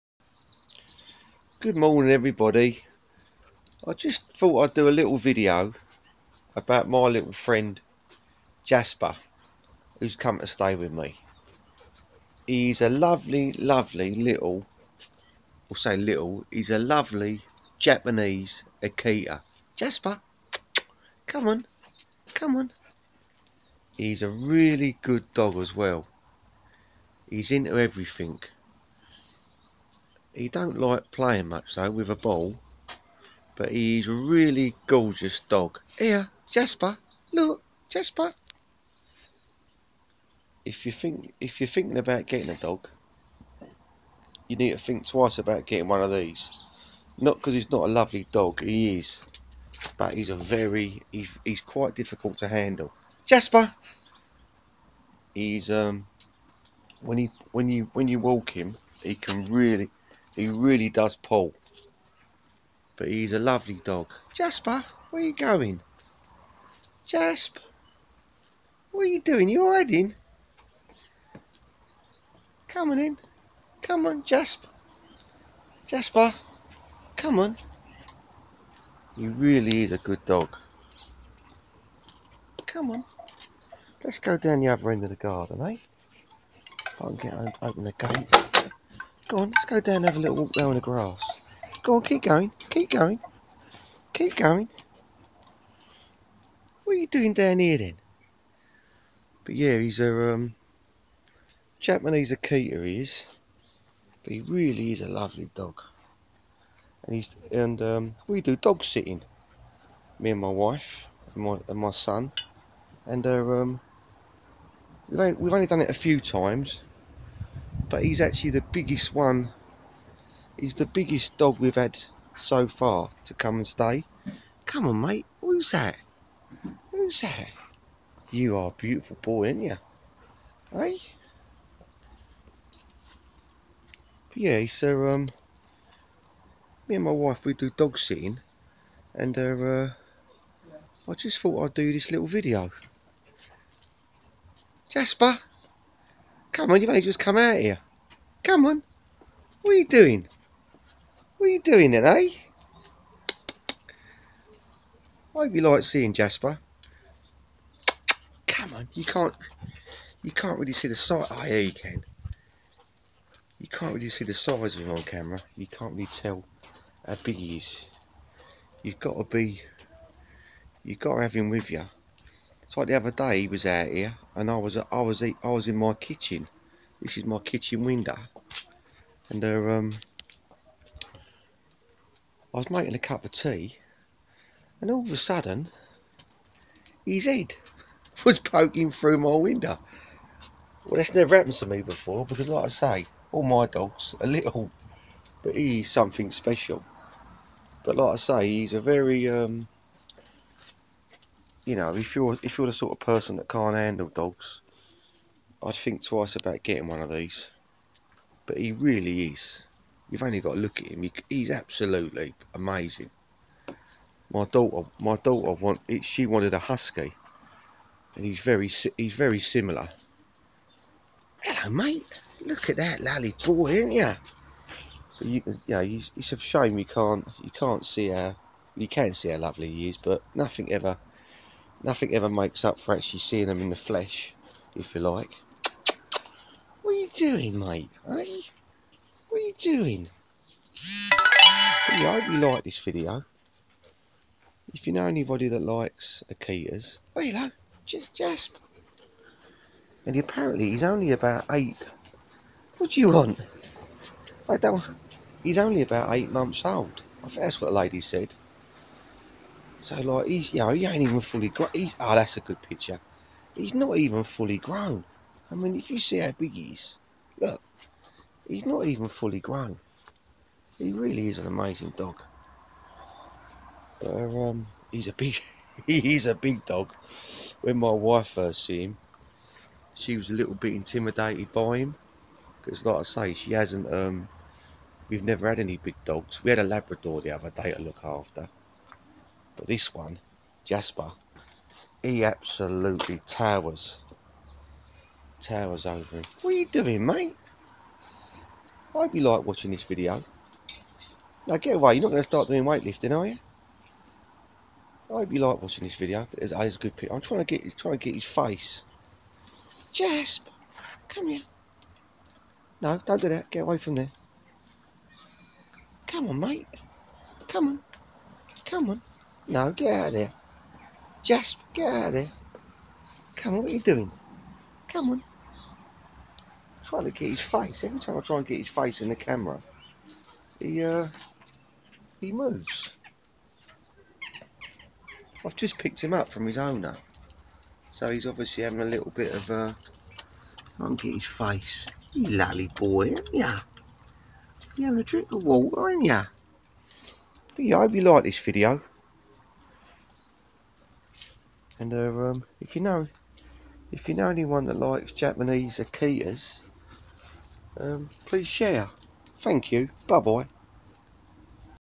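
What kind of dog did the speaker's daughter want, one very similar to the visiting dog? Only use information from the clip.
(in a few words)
husky.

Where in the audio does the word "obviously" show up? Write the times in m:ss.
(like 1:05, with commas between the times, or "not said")
5:38.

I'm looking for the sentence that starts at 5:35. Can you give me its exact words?
I've just picked him up from his owner.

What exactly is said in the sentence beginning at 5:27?
Every time I try and get his face in the camera, he, uh, he moves.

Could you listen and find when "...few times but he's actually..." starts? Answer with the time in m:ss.
1:55.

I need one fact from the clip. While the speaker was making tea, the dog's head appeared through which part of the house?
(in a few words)
kitchen window.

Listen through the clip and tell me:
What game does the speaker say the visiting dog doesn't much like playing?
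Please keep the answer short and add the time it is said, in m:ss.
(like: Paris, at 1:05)
ball, at 0:32.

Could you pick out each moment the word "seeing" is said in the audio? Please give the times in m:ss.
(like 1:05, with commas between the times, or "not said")
2:35, 3:53.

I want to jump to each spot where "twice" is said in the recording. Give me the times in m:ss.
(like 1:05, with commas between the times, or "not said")
0:45, 3:26.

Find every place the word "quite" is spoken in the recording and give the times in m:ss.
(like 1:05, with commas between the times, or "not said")
0:51.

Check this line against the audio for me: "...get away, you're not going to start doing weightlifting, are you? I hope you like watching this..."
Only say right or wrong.
right.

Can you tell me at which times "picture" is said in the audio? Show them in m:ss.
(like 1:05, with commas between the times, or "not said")
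4:22, 5:06.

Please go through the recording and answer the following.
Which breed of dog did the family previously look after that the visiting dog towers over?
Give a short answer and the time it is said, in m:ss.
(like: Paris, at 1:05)
Labrador, at 4:46.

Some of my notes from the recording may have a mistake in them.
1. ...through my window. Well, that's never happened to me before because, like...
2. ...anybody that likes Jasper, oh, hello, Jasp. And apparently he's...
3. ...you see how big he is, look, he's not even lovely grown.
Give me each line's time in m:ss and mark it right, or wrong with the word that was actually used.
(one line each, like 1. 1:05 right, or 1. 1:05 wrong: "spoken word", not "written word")
1. 3:08 right
2. 4:05 wrong: "Akitas", not "Jasper"
3. 4:25 wrong: "fully", not "lovely".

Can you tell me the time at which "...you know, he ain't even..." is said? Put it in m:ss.
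4:20.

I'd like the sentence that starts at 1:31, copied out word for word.
Go on, keep going, keep going, keep going.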